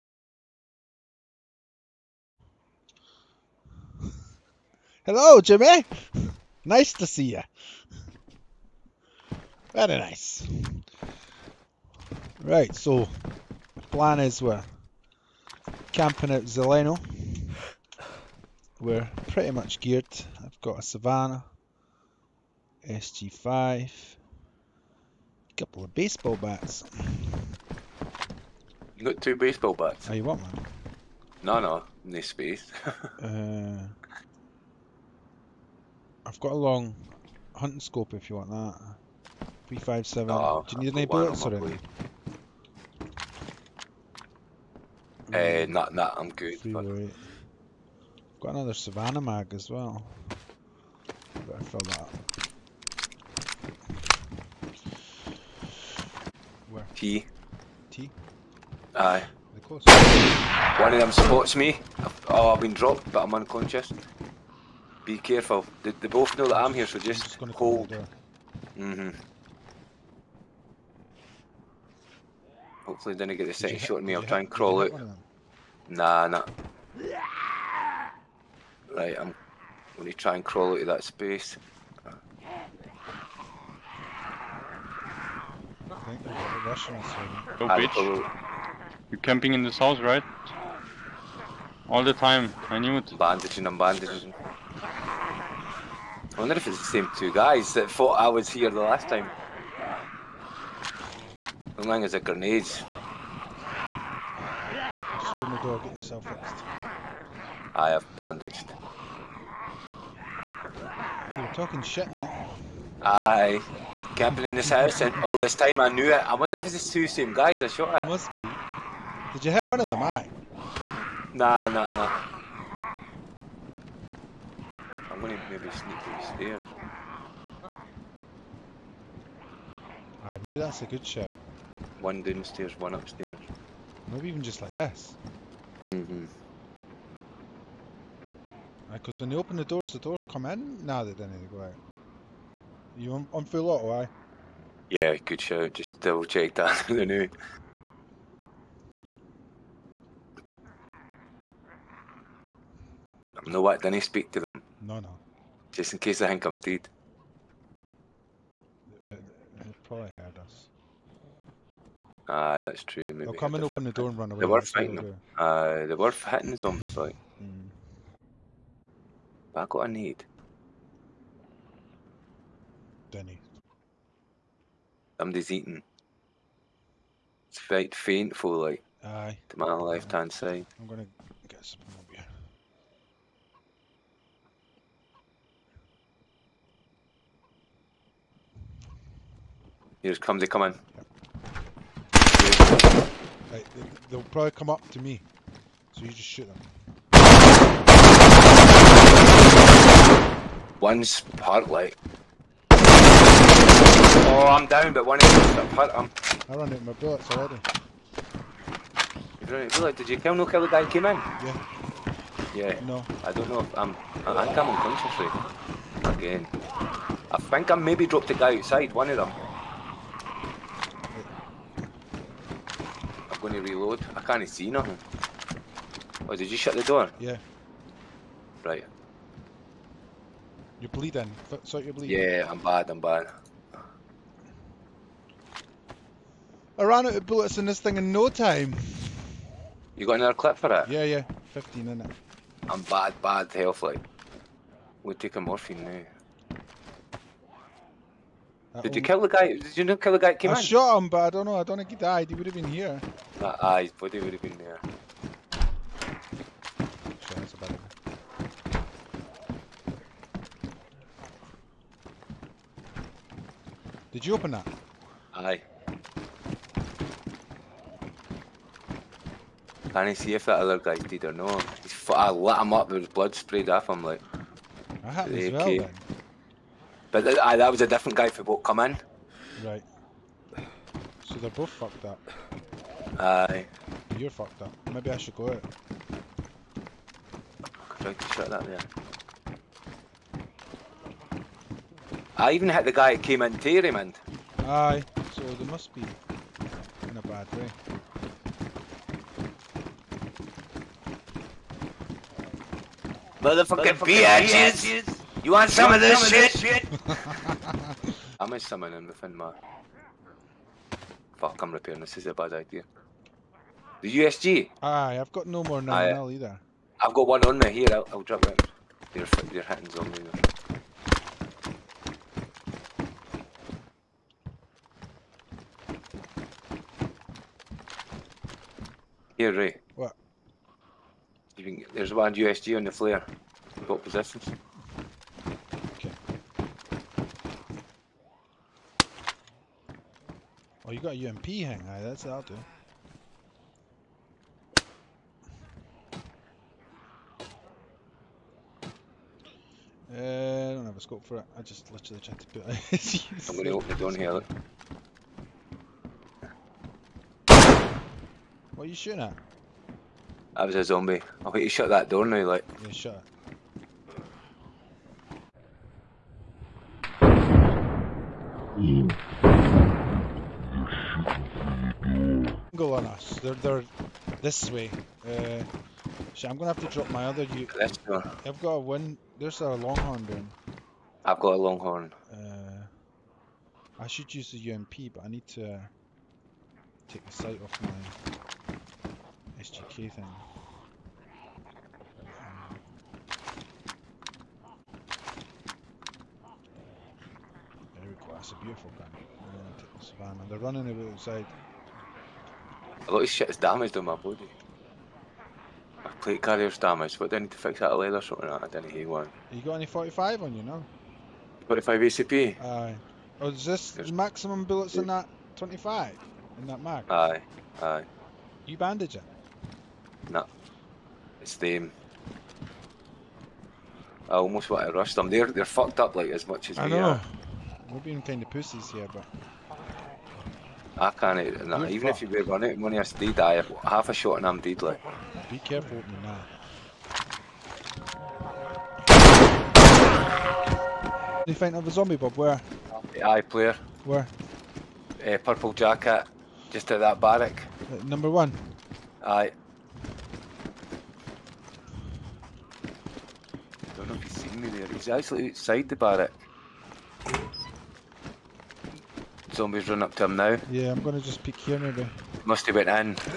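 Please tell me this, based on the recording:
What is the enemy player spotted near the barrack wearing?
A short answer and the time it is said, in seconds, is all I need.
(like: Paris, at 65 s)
purple jacket, at 445 s.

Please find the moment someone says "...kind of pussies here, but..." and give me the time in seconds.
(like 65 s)
428 s.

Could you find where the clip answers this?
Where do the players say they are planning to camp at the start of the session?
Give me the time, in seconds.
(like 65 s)
16 s.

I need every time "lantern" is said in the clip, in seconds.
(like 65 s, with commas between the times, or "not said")
not said.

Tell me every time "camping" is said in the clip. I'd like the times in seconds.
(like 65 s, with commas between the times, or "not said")
15 s, 89 s, 114 s.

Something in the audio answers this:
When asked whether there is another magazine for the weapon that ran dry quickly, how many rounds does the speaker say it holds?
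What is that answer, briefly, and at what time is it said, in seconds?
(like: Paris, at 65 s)
15, at 241 s.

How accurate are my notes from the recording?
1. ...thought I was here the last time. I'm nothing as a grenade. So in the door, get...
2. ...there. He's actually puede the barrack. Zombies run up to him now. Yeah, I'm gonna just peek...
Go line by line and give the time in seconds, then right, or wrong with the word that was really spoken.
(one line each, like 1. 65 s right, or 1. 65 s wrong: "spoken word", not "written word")
1. 97 s wrong: "lying", not "nothing"
2. 454 s wrong: "outside", not "puede".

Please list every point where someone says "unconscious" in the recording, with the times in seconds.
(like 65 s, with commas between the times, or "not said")
63 s, 214 s.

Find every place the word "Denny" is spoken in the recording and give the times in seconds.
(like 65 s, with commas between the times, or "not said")
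173 s.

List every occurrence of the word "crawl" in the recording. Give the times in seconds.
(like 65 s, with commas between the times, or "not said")
74 s, 80 s.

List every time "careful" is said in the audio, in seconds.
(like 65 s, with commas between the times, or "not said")
65 s, 435 s.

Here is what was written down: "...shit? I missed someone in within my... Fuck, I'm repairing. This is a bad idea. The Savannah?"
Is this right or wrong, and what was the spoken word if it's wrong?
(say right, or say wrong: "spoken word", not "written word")
wrong: "USG", not "Savannah".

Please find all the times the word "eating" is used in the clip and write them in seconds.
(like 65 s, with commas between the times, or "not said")
175 s.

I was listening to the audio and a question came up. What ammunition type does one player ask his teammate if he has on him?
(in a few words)
45 ACP.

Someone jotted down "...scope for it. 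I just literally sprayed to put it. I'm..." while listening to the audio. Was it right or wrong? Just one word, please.
wrong.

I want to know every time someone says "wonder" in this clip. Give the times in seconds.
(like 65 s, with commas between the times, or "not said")
96 s, 116 s.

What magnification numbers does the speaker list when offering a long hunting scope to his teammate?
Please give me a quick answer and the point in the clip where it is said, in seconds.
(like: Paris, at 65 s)
3, 5, 7, at 39 s.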